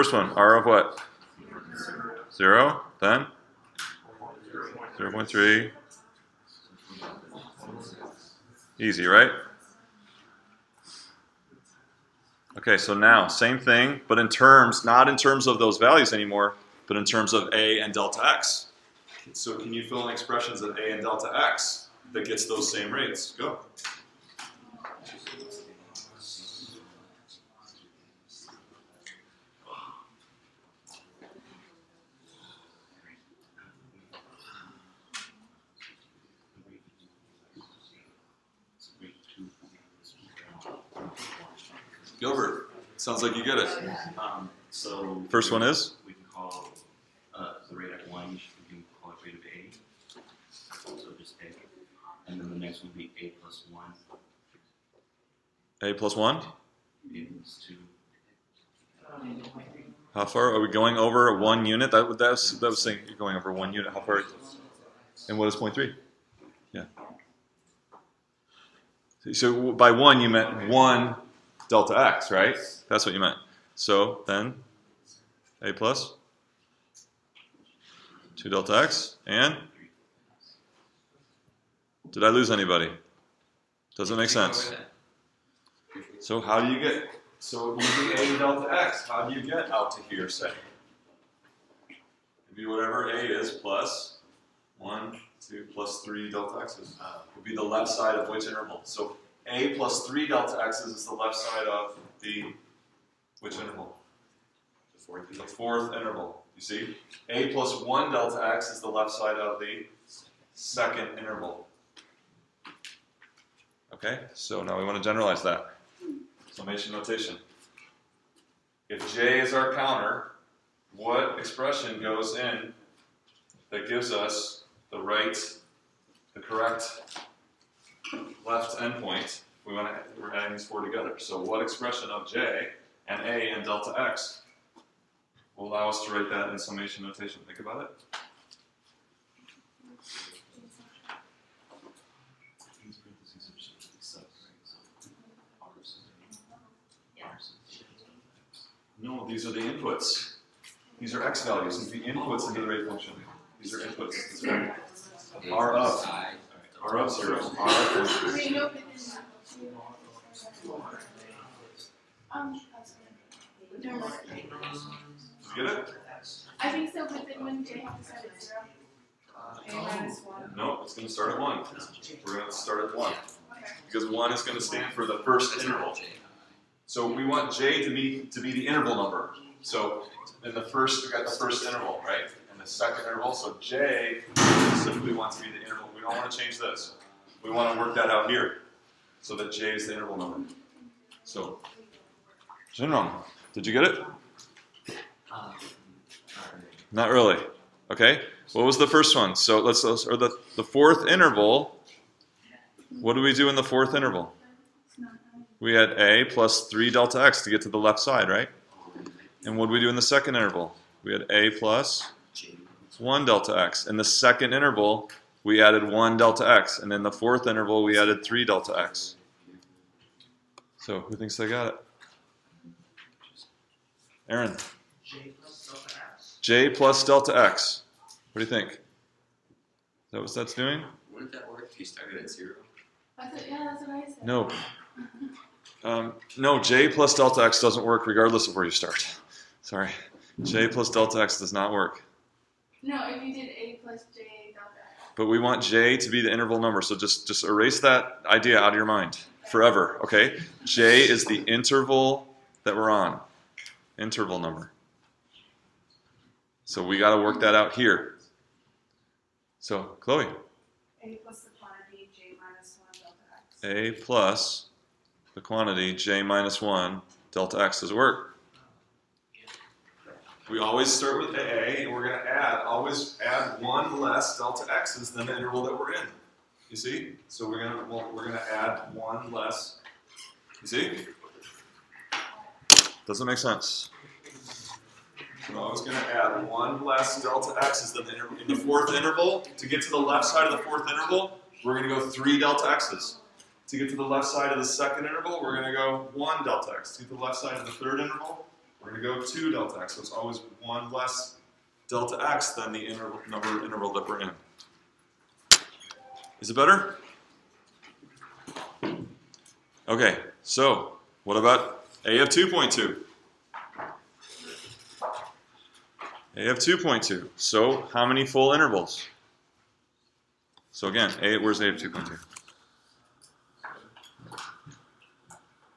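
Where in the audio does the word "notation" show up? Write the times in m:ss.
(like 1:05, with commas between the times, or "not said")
1:56, 2:17.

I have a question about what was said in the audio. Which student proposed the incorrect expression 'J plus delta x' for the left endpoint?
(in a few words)
Aaron.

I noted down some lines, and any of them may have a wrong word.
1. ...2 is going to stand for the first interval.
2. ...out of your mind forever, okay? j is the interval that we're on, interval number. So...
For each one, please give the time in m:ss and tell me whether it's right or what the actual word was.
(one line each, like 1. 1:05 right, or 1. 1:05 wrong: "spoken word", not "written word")
1. 2:54 wrong: "1", not "2"
2. 4:08 right.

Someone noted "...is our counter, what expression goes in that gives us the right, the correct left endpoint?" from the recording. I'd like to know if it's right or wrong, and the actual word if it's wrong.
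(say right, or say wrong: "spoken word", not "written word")
right.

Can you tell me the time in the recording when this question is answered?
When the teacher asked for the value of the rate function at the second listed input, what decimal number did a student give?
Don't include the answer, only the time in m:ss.
0:04.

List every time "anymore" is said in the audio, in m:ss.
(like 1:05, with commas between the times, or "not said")
0:16.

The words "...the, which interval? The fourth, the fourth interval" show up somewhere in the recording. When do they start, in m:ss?
1:42.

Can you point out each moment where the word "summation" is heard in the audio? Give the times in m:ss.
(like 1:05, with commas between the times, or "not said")
1:56, 2:16.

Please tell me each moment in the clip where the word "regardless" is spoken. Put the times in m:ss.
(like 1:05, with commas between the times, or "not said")
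3:58.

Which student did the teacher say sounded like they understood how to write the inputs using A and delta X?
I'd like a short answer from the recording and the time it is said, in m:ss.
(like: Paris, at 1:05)
Gilbert, at 0:42.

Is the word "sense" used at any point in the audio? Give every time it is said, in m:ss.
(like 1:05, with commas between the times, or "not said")
1:24, 4:43.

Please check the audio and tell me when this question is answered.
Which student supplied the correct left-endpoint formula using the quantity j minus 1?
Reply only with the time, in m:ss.
4:19.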